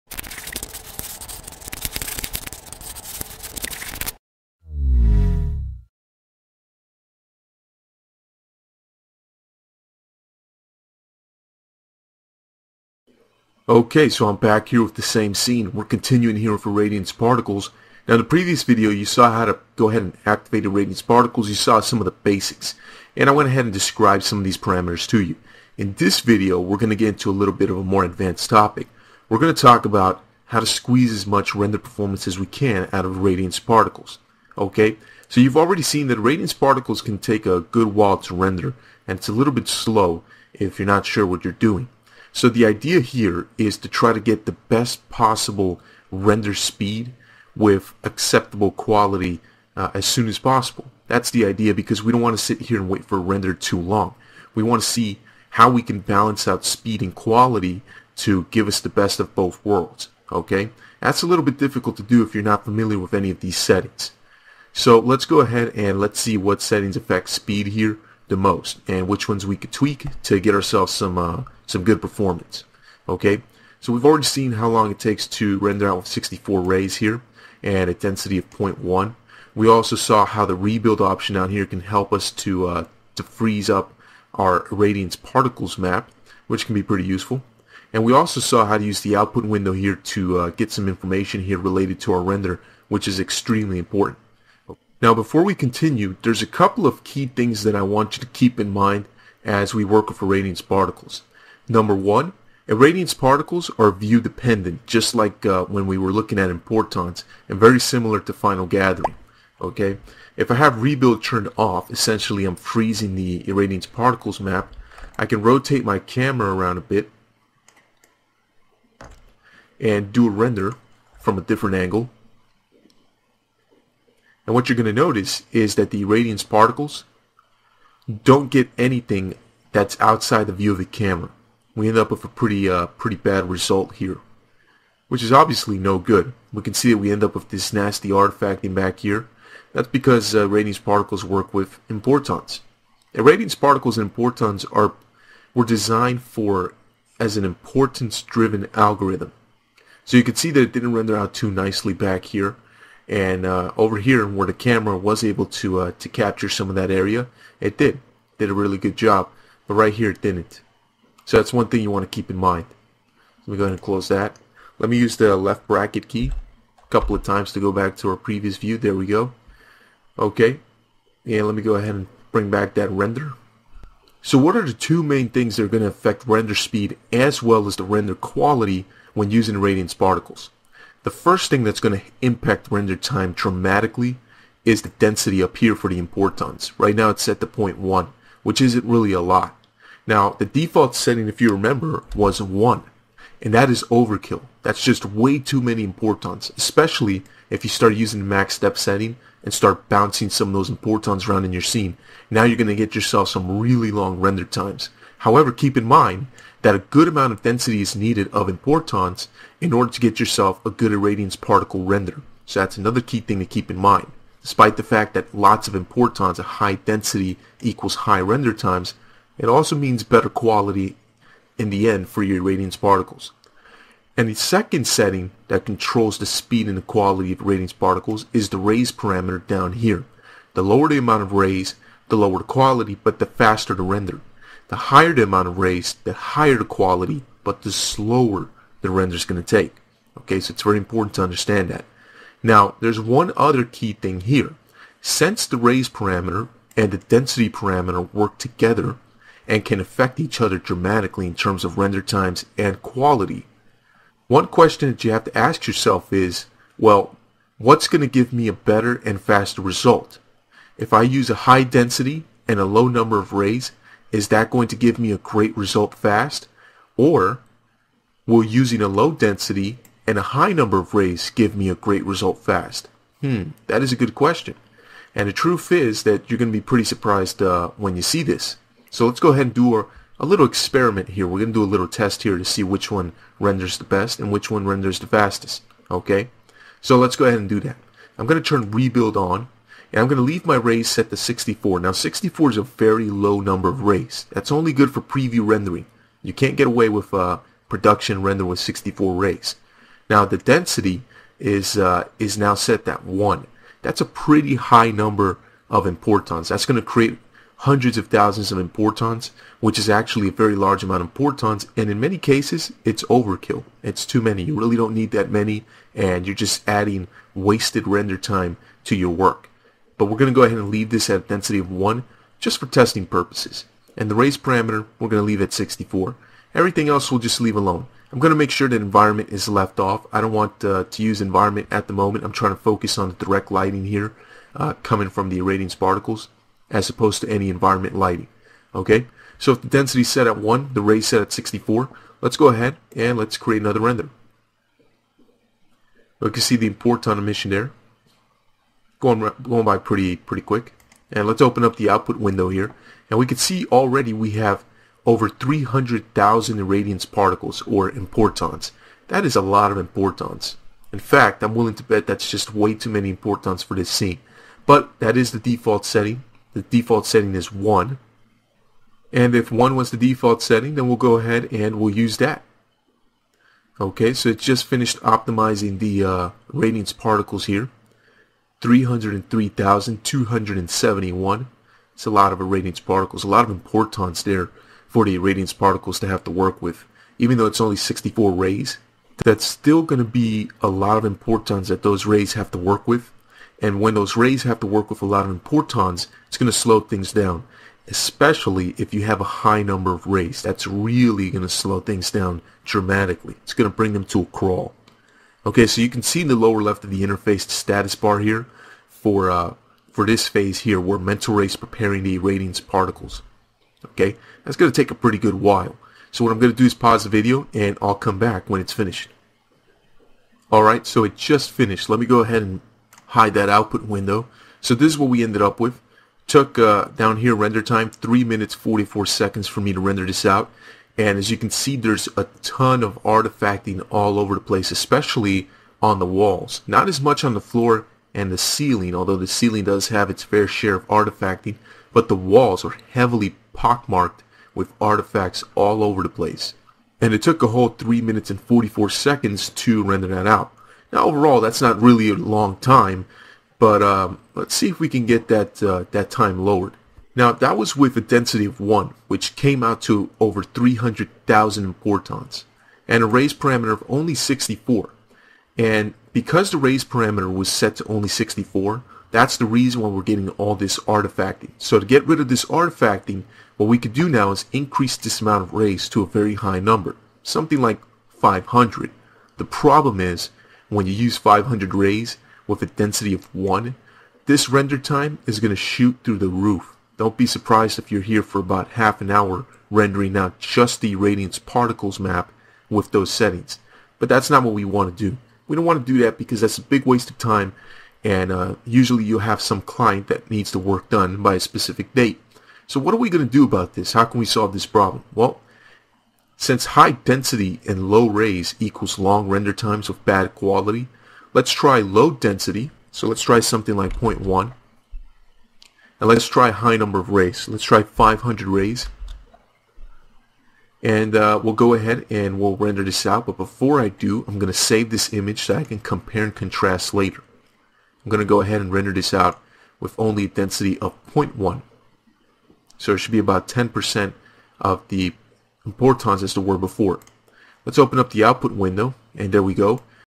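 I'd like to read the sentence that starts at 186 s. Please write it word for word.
Right now it's set to 0.1, which isn't really a lot.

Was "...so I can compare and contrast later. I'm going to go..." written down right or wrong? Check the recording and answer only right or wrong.
right.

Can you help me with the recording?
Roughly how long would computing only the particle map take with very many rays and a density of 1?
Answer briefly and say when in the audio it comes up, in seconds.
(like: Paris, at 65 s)
Half an hour, at 488 s.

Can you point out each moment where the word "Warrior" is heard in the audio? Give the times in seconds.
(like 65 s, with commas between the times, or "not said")
not said.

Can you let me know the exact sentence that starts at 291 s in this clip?
Now 64 is a very low number of rays.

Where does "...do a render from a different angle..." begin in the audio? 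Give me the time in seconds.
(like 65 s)
120 s.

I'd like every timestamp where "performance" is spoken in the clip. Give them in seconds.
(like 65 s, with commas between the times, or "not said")
31 s, 72 s.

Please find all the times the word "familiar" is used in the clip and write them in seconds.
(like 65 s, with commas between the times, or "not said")
62 s.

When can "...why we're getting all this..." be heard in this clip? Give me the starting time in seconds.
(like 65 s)
469 s.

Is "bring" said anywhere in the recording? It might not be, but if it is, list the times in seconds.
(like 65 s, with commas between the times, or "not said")
172 s, 403 s.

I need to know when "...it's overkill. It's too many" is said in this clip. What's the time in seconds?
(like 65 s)
312 s.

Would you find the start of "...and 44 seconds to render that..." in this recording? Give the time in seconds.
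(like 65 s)
448 s.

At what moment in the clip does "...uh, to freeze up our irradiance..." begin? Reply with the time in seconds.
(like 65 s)
82 s.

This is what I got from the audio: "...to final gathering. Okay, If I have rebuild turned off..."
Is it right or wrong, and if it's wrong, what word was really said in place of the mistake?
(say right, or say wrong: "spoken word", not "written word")
right.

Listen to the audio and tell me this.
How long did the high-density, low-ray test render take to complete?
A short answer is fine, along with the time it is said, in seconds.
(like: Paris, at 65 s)
3 minutes 44 seconds, at 427 s.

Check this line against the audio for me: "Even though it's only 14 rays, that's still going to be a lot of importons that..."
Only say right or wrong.
wrong.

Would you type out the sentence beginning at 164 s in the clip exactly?
Let me use the left bracket key a couple of times to go back to our previous view.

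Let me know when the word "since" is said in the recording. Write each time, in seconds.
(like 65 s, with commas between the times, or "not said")
245 s, 506 s.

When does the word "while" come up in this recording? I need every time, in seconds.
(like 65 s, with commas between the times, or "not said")
37 s, 415 s.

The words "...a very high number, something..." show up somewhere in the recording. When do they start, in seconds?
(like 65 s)
476 s.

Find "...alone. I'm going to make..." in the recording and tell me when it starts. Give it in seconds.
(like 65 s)
327 s.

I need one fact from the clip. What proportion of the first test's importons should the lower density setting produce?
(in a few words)
10%.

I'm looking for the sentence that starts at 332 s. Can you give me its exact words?
I'm trying to focus on the direct lighting here uh, coming from the irradiance particles as opposed to any environment lighting.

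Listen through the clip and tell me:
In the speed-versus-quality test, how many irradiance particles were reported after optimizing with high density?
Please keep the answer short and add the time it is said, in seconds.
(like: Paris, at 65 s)
303,271, at 378 s.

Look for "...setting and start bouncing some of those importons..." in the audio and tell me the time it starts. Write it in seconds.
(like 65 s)
198 s.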